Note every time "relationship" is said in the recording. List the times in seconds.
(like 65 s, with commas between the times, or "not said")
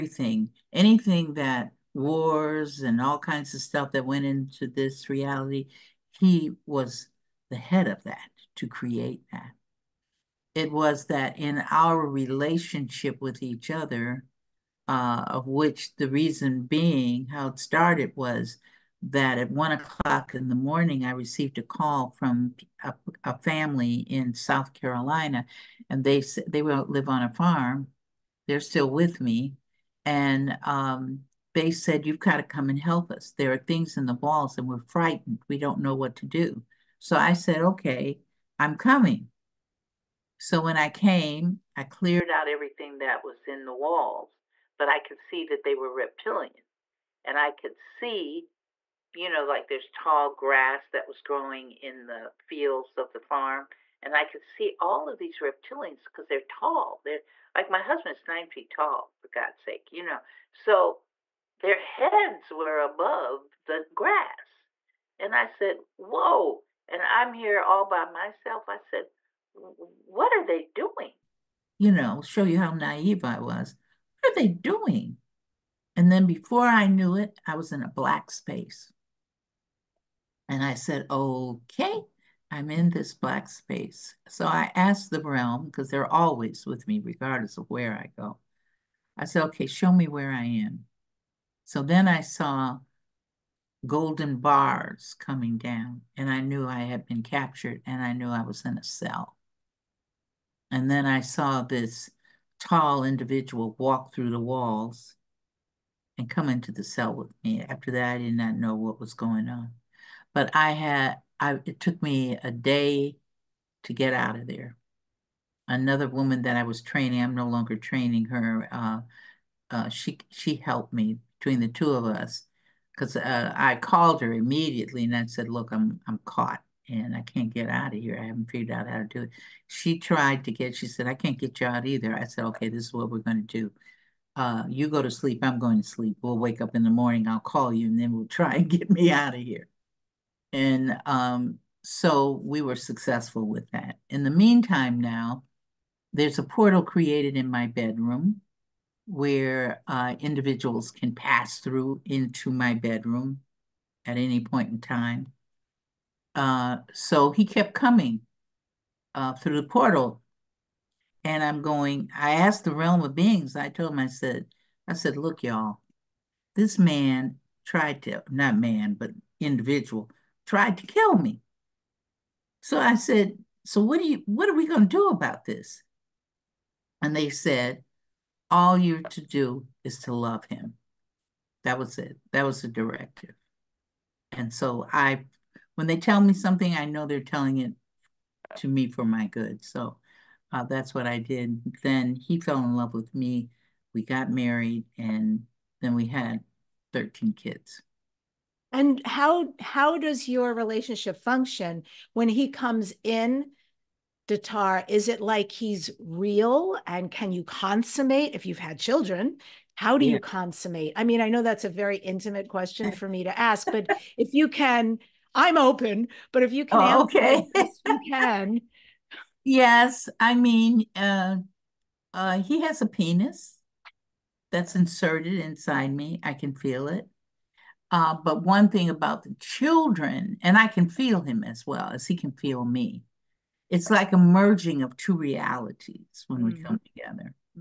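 12 s, 200 s.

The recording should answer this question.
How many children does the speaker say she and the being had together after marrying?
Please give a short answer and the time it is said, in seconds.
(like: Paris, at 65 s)
13, at 196 s.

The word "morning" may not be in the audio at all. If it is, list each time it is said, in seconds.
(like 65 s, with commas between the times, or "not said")
20 s, 136 s.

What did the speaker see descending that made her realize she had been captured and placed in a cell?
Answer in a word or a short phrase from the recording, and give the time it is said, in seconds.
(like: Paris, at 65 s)
Golden bars, at 93 s.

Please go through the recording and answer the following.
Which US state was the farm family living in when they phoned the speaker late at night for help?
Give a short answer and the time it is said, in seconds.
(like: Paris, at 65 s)
South Carolina, at 24 s.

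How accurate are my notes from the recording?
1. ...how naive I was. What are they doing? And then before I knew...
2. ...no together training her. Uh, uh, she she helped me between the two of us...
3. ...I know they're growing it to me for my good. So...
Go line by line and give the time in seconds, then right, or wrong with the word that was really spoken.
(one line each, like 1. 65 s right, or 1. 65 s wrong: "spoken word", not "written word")
1. 72 s right
2. 117 s wrong: "longer", not "together"
3. 186 s wrong: "telling", not "growing".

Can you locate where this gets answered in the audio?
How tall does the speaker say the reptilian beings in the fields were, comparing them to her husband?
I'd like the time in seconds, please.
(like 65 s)
58 s.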